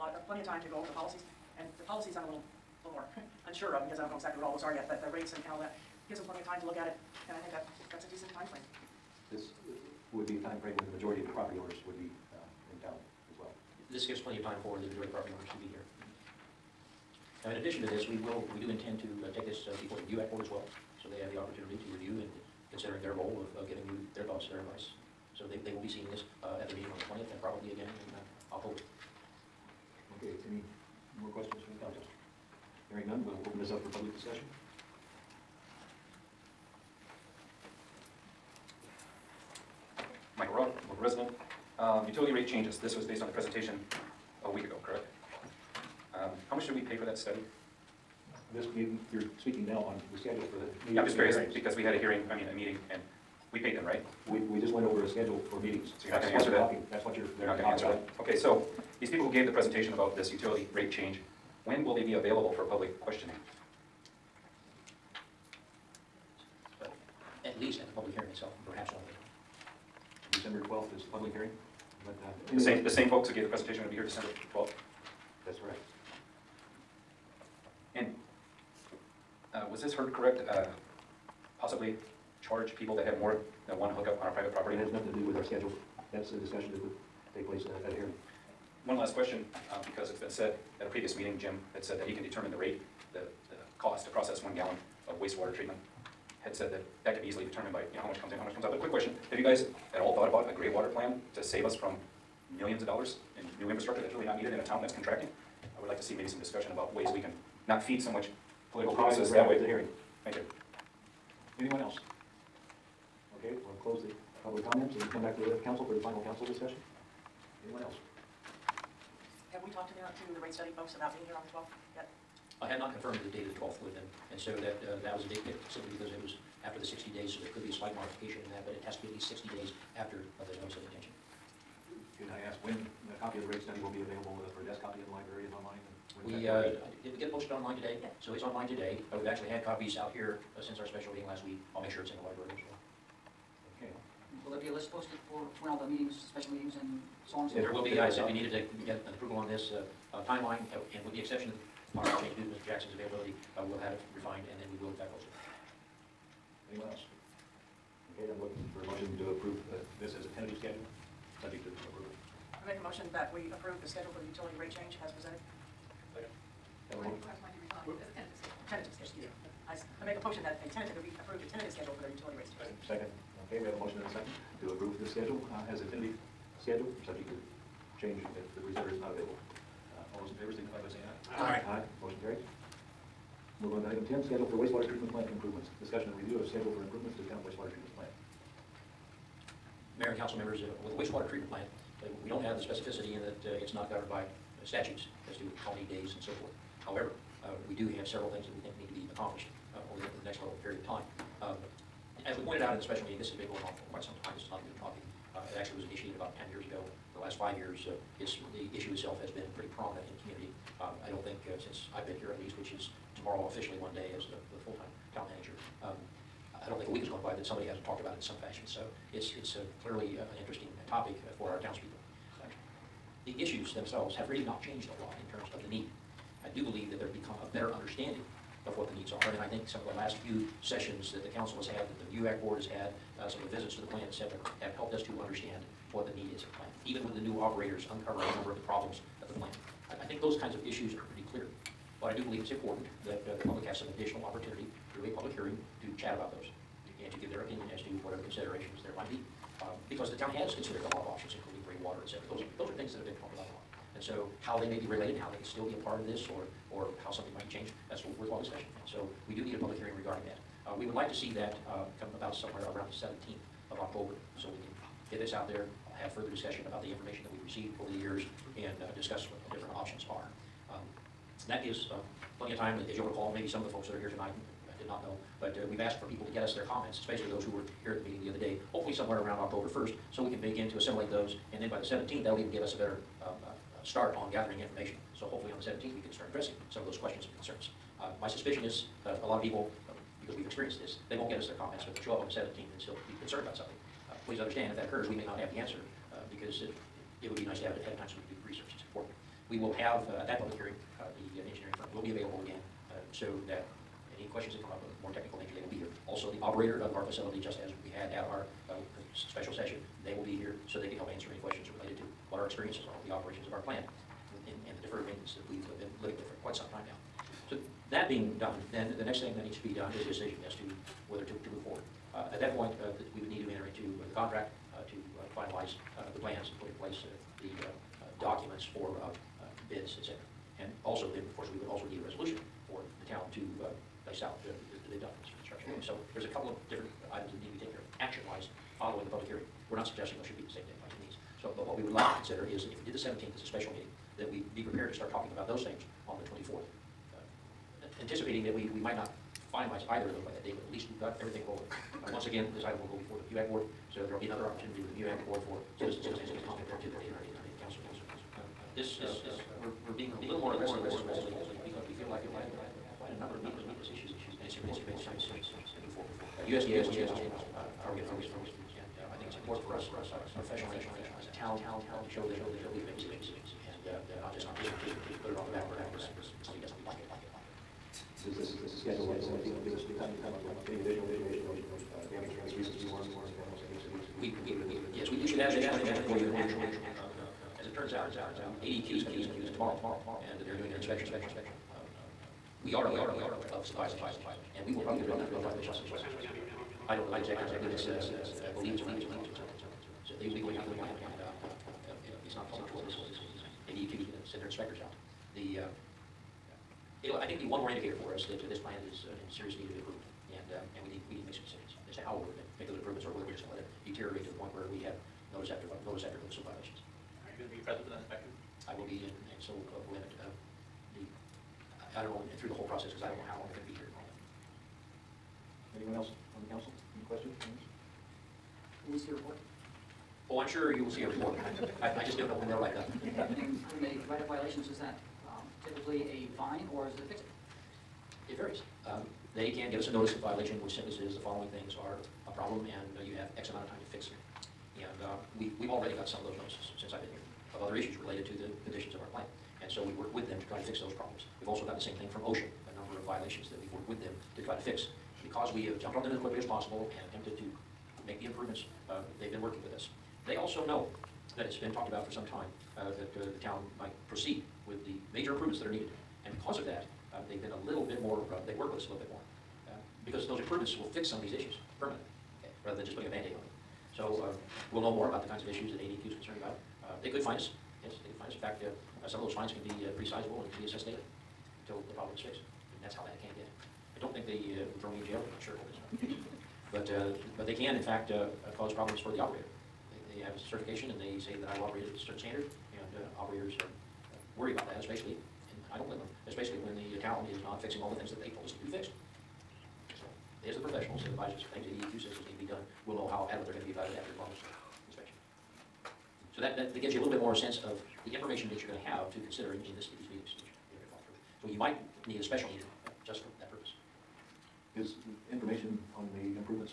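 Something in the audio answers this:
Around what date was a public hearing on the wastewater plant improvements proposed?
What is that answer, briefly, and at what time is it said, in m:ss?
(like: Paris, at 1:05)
October 17th, at 4:22.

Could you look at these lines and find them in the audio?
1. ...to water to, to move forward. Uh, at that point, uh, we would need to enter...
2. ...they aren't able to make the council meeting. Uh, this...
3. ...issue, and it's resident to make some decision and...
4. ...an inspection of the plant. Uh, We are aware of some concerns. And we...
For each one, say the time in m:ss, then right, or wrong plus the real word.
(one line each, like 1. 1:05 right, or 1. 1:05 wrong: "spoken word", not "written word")
1. 5:20 wrong: "whether", not "water"
2. 5:56 right
3. 6:03 wrong: "important", not "resident"
4. 6:30 wrong: "violations", not "concerns".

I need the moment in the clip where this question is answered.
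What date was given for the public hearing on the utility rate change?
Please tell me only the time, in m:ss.
1:10.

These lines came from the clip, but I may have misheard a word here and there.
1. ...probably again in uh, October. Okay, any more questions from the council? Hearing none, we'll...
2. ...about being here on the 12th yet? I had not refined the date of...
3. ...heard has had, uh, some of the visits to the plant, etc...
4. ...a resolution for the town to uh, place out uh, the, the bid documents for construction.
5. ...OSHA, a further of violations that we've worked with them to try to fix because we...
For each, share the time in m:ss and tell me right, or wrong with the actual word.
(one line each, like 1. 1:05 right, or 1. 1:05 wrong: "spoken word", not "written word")
1. 0:27 right
2. 2:00 wrong: "confirmed", not "refined"
3. 3:52 wrong: "board", not "heard"
4. 5:31 right
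5. 7:32 wrong: "number", not "further".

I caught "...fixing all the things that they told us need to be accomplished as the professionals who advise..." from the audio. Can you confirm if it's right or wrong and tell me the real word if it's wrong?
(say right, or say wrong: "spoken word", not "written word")
wrong: "fixed", not "accomplished".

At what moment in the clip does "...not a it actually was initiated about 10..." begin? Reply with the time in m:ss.
3:24.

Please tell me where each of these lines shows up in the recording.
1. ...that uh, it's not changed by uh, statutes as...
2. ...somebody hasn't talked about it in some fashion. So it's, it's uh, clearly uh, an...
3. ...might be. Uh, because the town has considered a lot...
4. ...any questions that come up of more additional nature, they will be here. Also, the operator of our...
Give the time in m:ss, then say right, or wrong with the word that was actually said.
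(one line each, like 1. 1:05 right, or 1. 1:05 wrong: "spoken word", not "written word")
1. 3:13 wrong: "governed", not "changed"
2. 3:37 right
3. 4:08 right
4. 5:04 wrong: "technical", not "additional".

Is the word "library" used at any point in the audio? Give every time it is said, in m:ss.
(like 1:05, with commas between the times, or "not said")
2:15, 2:22.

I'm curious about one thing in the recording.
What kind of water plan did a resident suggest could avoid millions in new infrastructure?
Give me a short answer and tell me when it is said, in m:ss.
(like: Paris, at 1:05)
gray water plan, at 1:40.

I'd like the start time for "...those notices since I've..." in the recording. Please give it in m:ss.
7:26.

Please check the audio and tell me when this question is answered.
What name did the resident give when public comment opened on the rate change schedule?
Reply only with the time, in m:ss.
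0:40.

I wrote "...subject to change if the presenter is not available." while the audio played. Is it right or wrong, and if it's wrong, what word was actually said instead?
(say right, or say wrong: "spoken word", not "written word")
right.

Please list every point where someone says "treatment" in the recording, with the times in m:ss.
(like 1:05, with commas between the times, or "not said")
1:35, 3:04, 3:11.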